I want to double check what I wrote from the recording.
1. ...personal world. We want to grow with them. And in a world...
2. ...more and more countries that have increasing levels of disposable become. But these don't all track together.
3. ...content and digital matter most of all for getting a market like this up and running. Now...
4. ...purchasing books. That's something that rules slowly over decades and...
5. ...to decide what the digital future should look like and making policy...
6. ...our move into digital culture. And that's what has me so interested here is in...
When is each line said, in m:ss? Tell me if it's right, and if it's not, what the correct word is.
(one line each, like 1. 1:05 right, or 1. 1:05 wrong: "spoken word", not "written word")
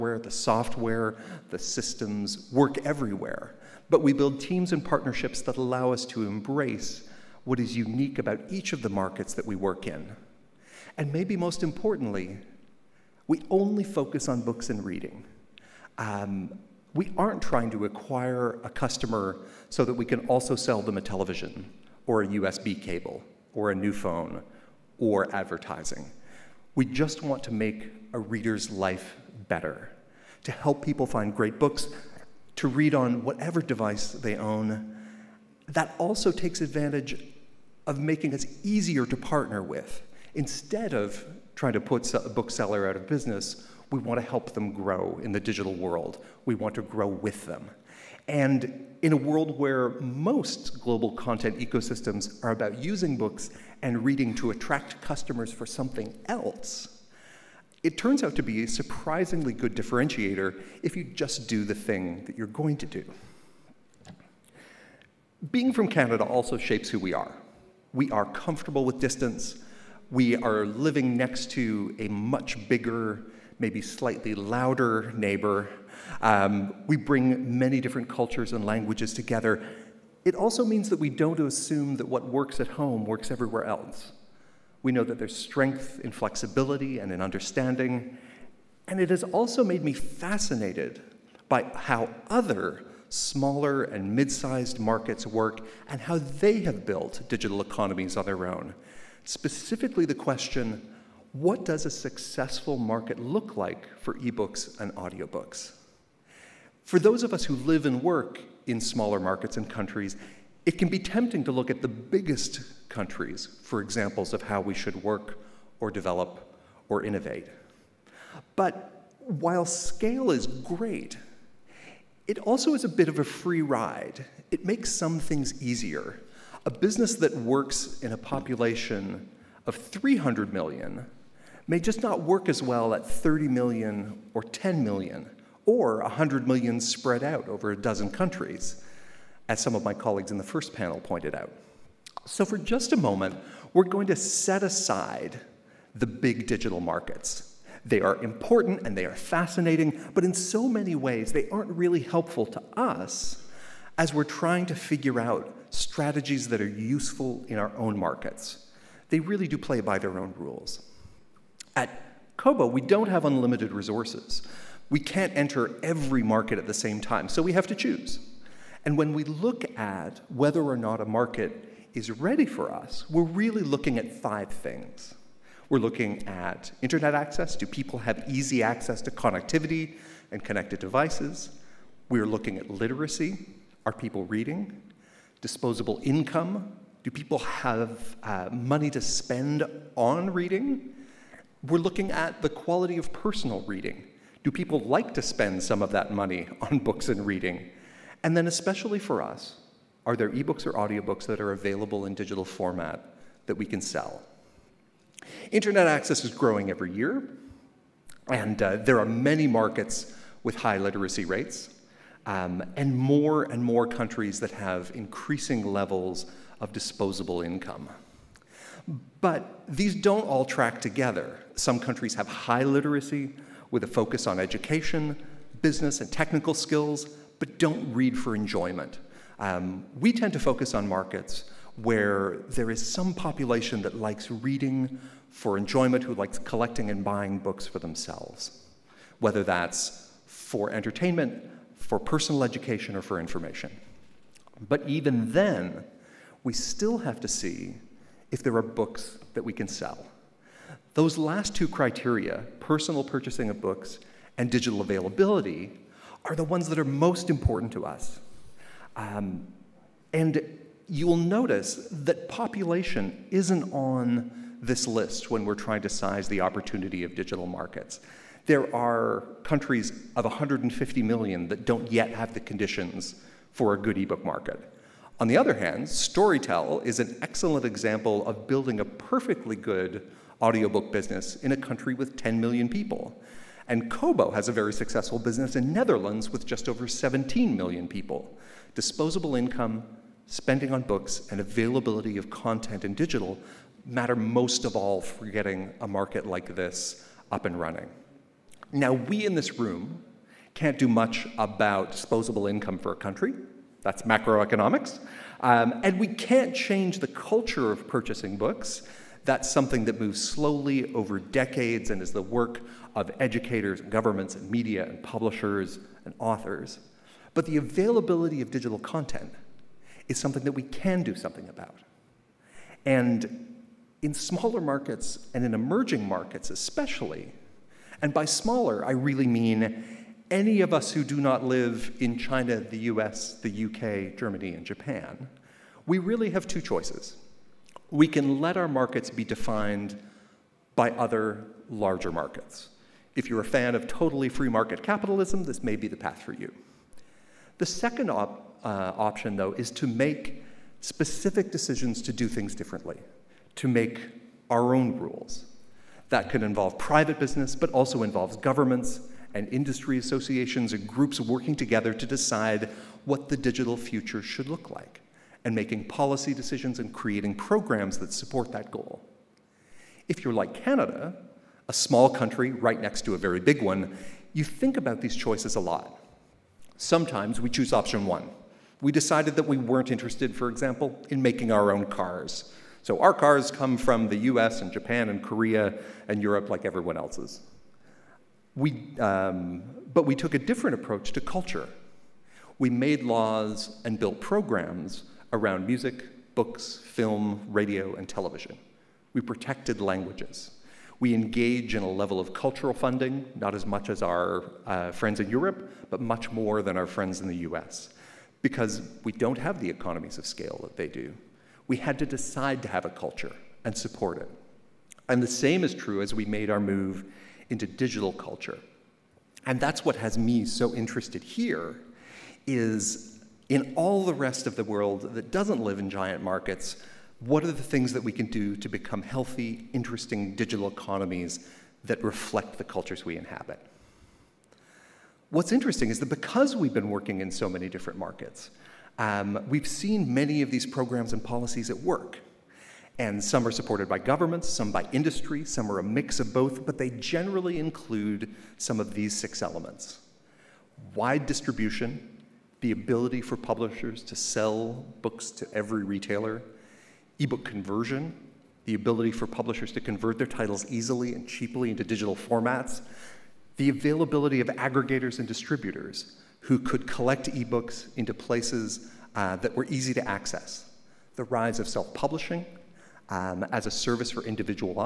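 1. 0:45 wrong: "digital", not "personal"
2. 3:32 wrong: "income", not "become"
3. 4:52 right
4. 5:07 wrong: "moves", not "rules"
5. 6:01 right
6. 6:56 right.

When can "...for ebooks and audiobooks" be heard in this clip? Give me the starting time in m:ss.
1:43.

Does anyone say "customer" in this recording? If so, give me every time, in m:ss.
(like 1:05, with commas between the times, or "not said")
0:18, 0:55.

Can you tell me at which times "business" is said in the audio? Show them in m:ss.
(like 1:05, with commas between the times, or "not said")
0:43, 2:06, 3:45, 4:40, 4:45, 5:57.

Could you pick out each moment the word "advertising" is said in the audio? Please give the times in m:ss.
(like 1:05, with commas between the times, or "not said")
0:25.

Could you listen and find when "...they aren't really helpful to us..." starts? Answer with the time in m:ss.
2:31.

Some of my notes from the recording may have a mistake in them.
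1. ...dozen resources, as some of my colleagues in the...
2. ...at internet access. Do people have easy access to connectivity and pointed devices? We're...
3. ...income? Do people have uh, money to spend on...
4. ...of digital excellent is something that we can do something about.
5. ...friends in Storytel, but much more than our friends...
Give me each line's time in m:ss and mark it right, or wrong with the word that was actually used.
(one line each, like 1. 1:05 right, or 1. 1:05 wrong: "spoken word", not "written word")
1. 2:17 wrong: "countries", not "resources"
2. 2:56 wrong: "connected", not "pointed"
3. 3:06 right
4. 5:18 wrong: "content", not "excellent"
5. 6:44 wrong: "Europe", not "Storytel".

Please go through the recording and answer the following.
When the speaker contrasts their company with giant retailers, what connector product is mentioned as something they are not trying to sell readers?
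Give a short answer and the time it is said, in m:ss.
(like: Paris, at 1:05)
USB cable, at 0:22.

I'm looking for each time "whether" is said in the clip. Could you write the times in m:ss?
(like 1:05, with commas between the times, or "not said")
2:50, 3:59.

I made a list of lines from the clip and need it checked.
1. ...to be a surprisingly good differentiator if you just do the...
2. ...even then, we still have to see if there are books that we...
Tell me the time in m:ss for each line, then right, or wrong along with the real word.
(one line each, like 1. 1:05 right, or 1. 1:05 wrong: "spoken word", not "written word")
1. 0:58 right
2. 4:04 right.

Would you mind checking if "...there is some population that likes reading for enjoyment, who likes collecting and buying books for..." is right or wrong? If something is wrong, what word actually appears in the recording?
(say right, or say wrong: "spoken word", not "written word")
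right.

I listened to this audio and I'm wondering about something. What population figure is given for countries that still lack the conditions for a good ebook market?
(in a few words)
150 million.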